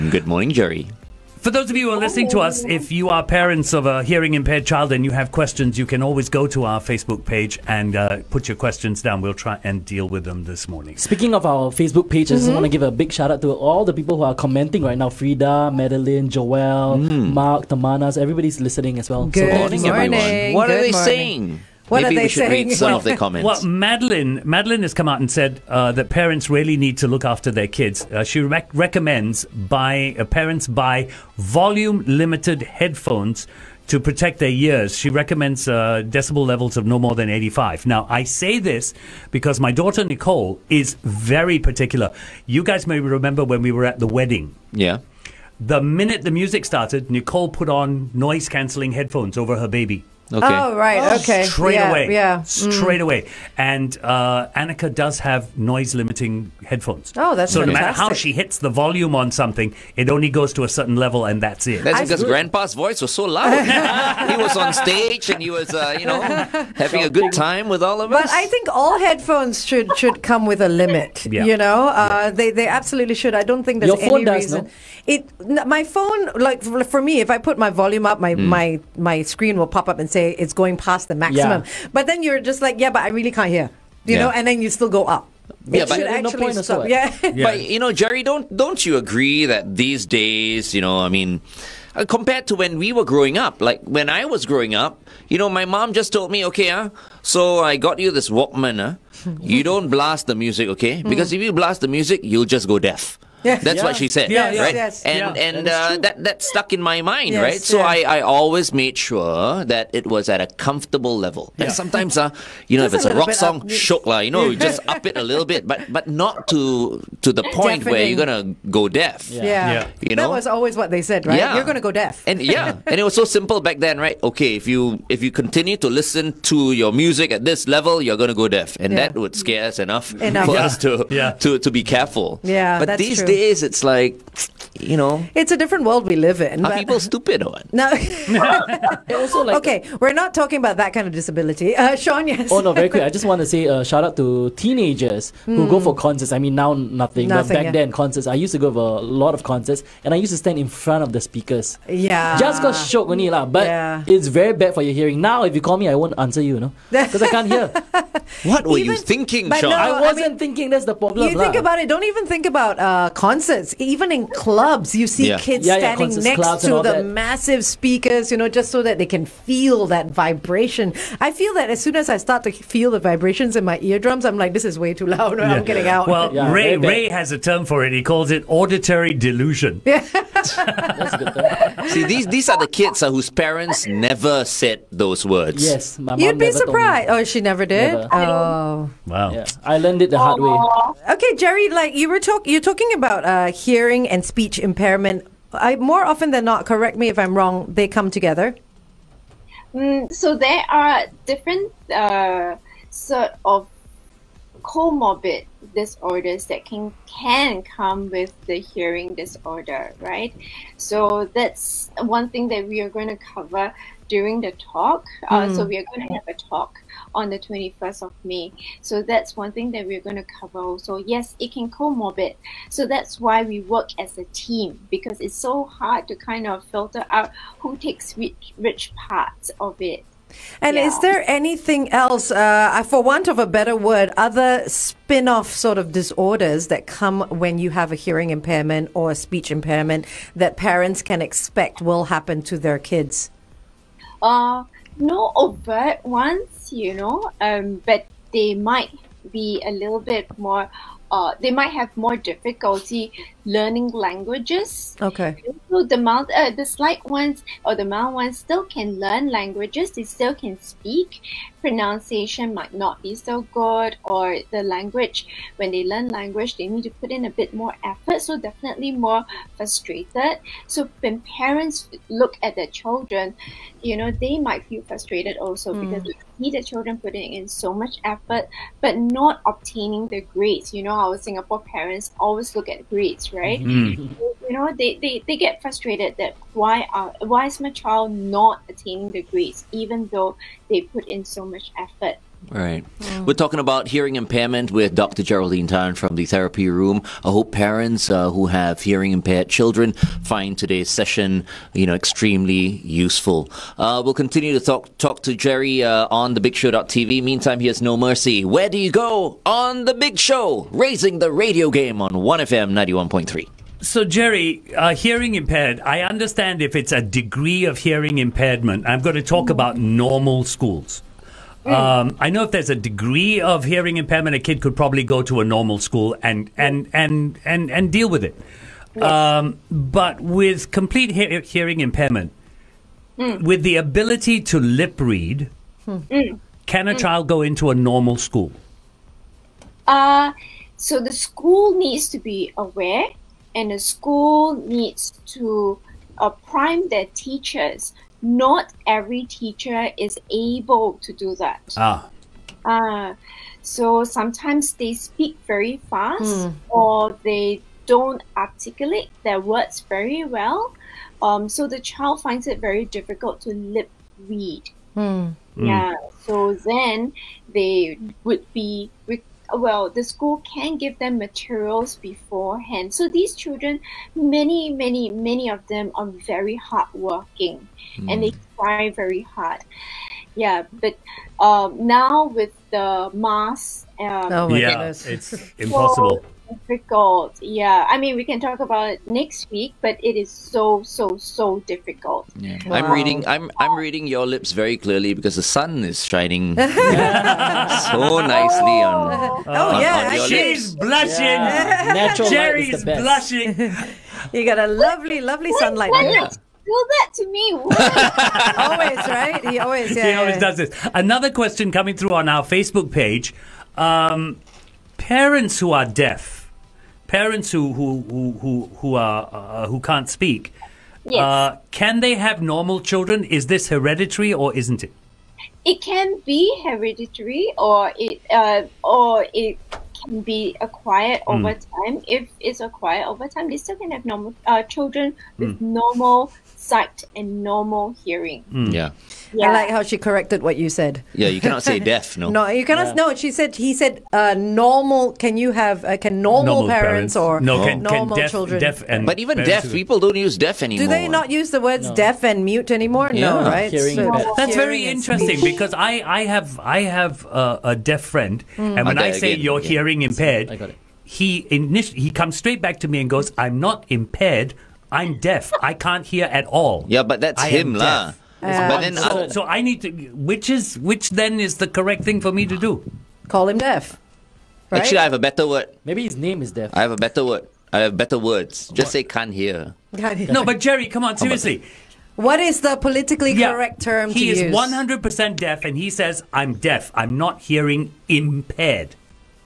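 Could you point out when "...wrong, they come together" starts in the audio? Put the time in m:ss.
3:17.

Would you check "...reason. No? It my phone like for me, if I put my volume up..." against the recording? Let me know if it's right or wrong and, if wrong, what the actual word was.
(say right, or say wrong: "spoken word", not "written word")
right.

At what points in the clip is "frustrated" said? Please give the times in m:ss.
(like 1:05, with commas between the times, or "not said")
4:29, 4:34, 4:45.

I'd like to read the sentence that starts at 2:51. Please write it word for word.
I feel that as soon as I start to feel the vibrations in my eardrums, I'm like, this is way too loud.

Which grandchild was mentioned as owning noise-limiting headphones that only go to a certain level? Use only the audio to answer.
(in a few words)
Annika.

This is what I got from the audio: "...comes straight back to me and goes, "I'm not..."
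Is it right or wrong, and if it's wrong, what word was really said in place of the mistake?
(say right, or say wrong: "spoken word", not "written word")
right.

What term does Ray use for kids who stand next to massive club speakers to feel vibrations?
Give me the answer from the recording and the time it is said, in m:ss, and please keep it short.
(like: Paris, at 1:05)
auditory delusion, at 2:58.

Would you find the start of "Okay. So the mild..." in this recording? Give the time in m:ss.
4:15.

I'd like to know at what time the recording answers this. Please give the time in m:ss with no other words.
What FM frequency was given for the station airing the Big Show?
5:12.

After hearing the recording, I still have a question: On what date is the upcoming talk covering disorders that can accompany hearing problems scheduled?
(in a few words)
21 May.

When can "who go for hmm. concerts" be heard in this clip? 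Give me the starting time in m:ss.
2:25.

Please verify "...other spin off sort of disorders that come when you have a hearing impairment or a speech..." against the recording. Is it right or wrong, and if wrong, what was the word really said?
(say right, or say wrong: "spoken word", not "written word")
right.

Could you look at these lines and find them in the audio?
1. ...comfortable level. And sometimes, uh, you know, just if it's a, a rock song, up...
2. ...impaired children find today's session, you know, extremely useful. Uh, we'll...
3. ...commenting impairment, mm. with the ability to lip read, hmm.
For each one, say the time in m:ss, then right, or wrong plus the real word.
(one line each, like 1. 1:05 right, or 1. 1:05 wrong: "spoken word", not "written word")
1. 1:50 right
2. 4:59 right
3. 5:31 wrong: "hearing", not "commenting".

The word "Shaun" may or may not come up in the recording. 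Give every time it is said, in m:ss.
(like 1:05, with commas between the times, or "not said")
2:21, 2:39.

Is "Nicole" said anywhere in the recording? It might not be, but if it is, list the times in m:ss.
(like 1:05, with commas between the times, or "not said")
0:40, 0:47.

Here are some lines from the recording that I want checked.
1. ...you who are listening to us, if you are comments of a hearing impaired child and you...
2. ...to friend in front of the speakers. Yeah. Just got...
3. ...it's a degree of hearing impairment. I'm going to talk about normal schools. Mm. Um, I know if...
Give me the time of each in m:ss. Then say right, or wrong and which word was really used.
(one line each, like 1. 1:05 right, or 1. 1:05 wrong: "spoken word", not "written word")
1. 0:01 wrong: "parents", not "comments"
2. 2:30 wrong: "stand", not "friend"
3. 5:16 right.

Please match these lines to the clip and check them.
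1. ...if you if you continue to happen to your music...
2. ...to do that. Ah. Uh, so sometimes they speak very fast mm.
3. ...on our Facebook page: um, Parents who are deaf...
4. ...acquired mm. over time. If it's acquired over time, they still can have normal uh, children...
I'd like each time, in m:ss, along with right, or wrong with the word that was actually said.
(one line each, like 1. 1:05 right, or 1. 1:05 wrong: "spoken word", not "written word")
1. 2:04 wrong: "listen", not "happen"
2. 5:51 right
3. 6:52 right
4. 7:10 right.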